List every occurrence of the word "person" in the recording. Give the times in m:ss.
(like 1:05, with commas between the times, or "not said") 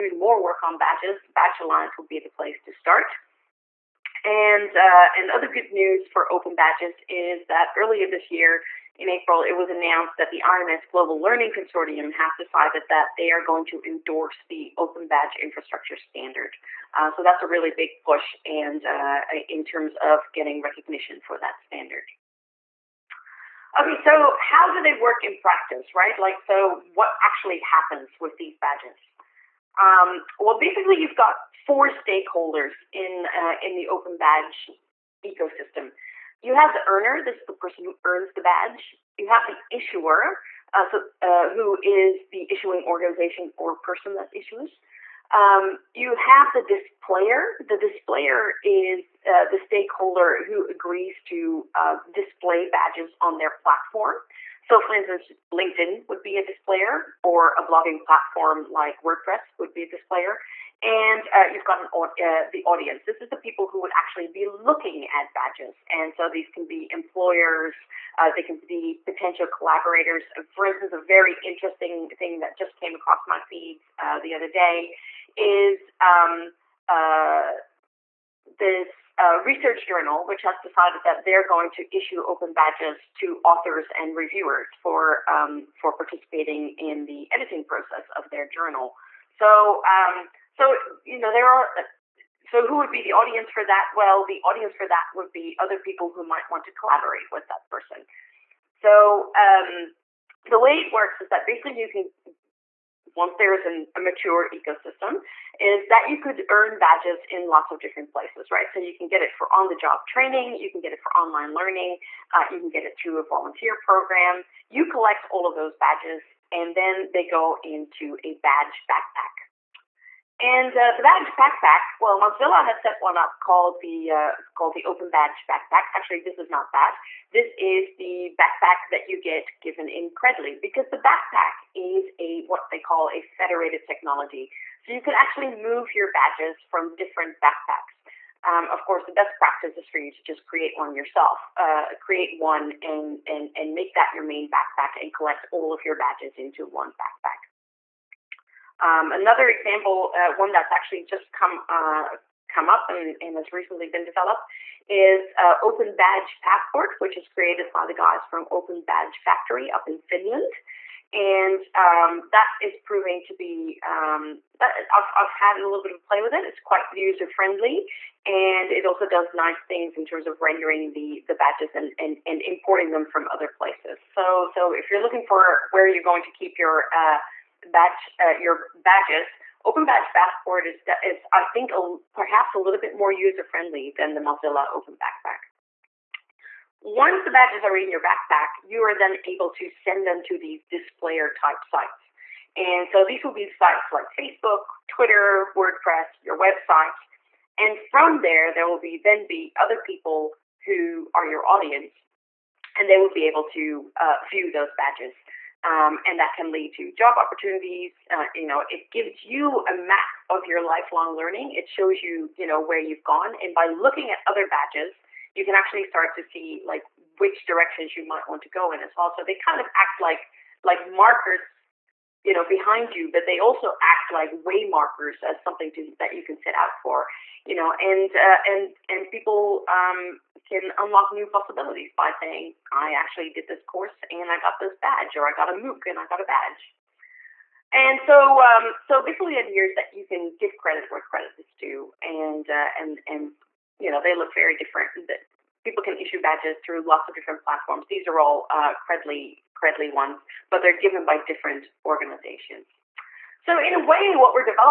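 0:37, 0:43, 1:37.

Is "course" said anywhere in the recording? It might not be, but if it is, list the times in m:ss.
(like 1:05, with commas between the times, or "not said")
2:18, 3:53.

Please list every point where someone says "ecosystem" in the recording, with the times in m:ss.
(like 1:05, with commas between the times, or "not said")
0:35, 1:44.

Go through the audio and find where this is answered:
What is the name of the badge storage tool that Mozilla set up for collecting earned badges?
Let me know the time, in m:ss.
2:04.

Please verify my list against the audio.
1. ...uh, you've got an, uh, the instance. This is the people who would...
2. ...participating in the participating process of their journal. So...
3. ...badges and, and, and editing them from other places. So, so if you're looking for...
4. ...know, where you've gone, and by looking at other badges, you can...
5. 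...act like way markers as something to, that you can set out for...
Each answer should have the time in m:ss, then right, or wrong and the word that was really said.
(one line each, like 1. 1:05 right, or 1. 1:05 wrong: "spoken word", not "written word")
1. 1:01 wrong: "audience", not "instance"
2. 1:25 wrong: "editing", not "participating"
3. 2:51 wrong: "importing", not "editing"
4. 3:32 right
5. 3:43 right.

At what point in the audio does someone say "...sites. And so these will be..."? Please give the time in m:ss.
3:11.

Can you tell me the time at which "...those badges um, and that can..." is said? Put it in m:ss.
3:24.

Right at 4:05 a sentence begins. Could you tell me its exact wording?
People can issue badges through lots of different platforms.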